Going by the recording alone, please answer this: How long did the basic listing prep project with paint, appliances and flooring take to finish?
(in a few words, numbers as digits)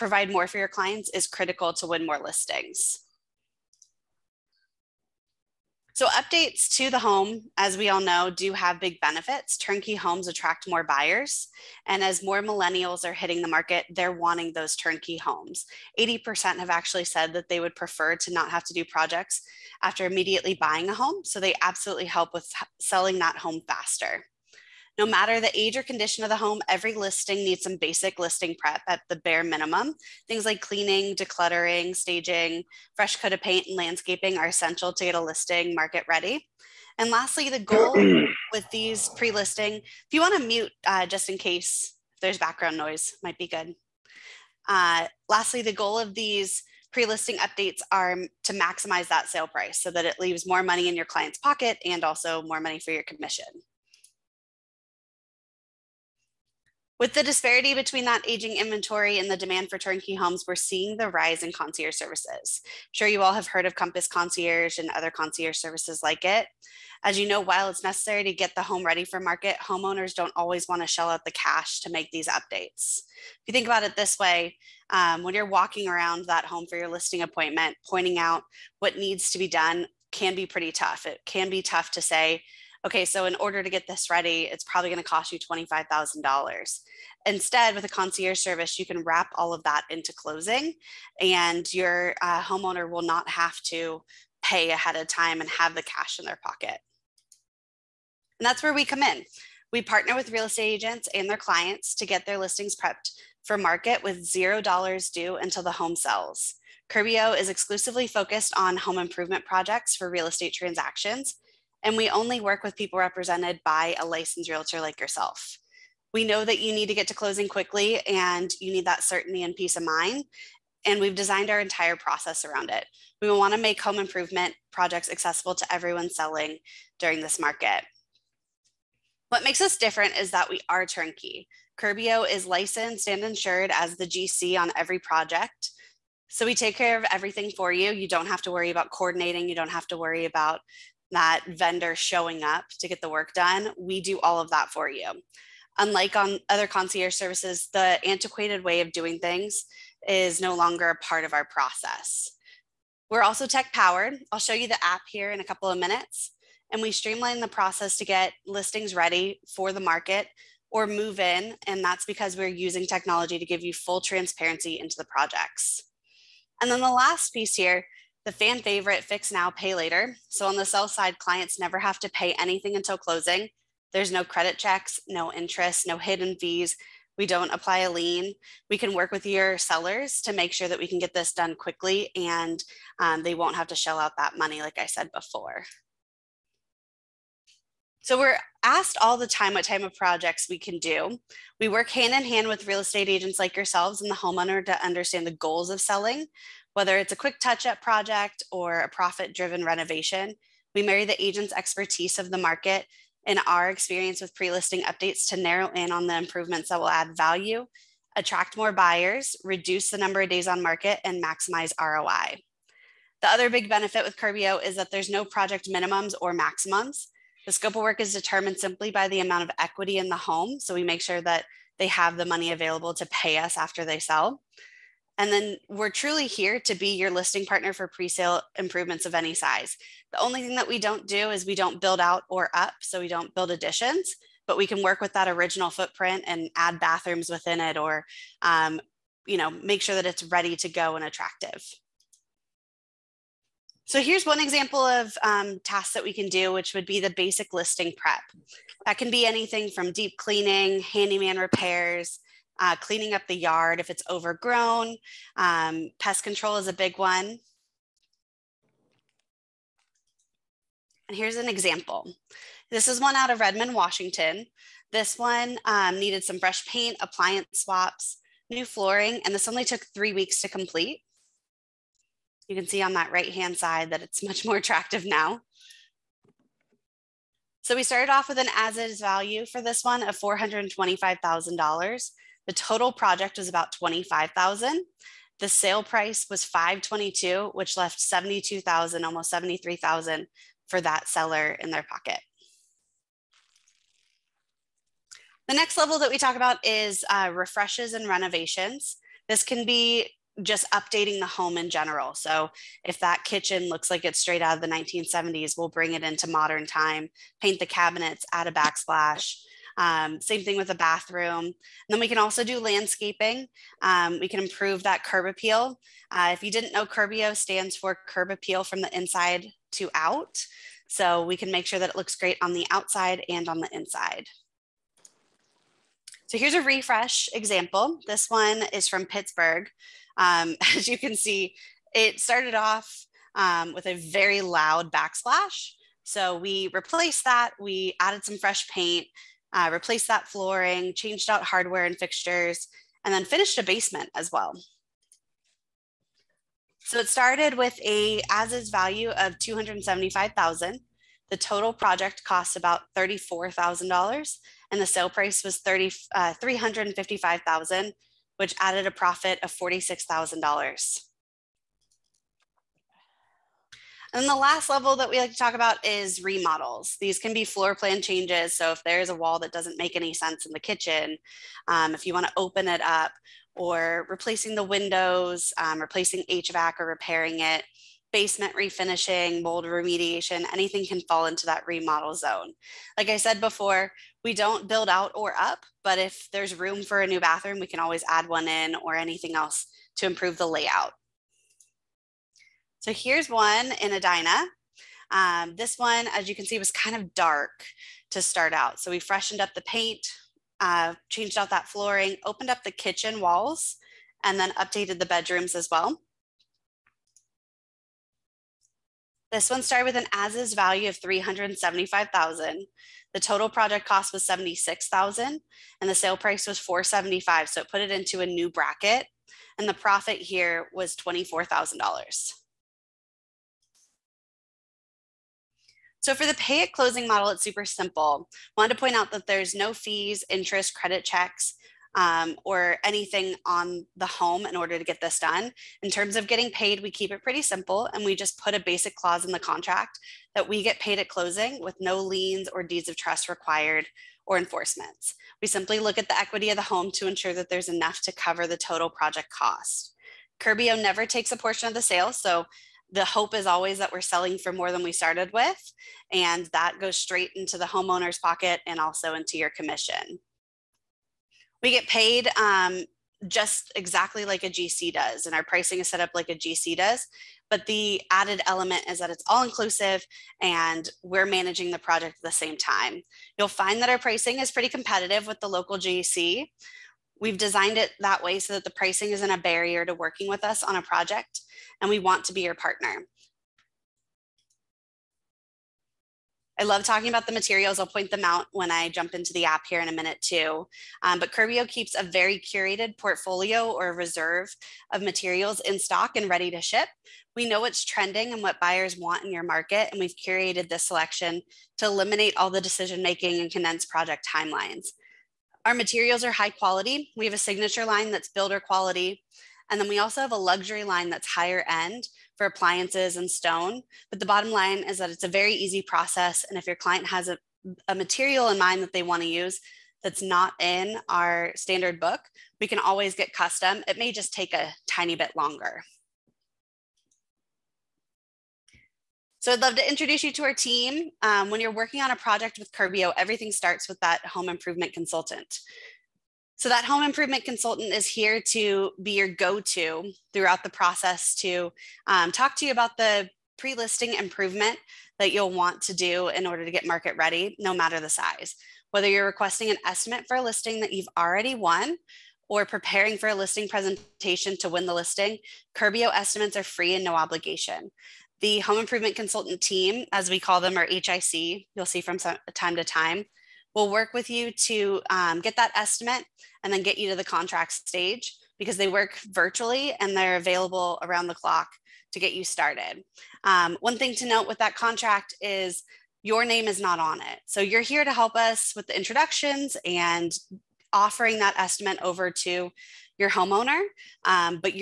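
3 weeks.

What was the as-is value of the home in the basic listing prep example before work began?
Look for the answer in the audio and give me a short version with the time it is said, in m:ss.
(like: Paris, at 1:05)
$425,000, at 4:40.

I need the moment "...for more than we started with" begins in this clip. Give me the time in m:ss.
7:34.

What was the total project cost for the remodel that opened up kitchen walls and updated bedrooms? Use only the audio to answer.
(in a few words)
$76,000.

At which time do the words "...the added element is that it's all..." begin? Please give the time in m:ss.
7:47.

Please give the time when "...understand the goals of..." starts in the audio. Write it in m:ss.
3:14.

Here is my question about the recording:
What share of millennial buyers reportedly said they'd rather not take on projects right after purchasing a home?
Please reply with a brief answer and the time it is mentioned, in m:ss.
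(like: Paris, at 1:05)
80%, at 0:15.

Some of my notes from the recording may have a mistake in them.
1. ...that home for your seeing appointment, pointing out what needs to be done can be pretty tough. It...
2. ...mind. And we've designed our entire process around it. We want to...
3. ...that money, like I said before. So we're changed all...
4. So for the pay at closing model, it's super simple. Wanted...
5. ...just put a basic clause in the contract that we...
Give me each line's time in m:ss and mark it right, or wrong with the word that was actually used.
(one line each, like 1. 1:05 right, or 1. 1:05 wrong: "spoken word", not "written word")
1. 1:16 wrong: "listing", not "seeing"
2. 1:59 right
3. 3:04 wrong: "asked", not "changed"
4. 7:06 right
5. 7:18 right.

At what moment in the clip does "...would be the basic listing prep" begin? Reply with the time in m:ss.
4:06.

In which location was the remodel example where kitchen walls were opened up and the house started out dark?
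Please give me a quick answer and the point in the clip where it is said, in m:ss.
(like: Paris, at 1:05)
Edina, at 6:33.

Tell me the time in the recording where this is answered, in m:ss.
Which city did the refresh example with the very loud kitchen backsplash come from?
5:29.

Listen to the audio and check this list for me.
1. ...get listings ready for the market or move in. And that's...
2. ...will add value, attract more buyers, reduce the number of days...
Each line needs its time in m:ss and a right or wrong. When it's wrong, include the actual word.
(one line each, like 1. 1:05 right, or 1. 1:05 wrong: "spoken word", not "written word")
1. 2:38 right
2. 3:26 right.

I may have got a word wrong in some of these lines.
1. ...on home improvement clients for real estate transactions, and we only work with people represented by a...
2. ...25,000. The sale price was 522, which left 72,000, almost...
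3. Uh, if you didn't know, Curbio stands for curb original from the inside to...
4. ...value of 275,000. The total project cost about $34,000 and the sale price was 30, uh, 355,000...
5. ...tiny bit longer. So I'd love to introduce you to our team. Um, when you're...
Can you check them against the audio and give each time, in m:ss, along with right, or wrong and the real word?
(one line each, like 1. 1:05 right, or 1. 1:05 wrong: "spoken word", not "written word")
1. 1:48 wrong: "projects", not "clients"
2. 4:43 right
3. 5:16 wrong: "appeal", not "original"
4. 5:48 right
5. 8:44 right.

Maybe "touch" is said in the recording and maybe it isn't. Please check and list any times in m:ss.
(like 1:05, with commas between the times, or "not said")
3:17.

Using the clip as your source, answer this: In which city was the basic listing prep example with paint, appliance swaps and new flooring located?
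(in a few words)
Redmond, Washington.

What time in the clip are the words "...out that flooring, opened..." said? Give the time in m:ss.
6:41.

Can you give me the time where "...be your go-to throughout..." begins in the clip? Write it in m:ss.
8:59.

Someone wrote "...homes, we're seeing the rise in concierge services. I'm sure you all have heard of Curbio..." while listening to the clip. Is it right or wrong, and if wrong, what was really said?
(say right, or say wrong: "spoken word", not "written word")
wrong: "Compass", not "Curbio".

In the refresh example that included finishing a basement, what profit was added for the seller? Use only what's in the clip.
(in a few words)
$46,000.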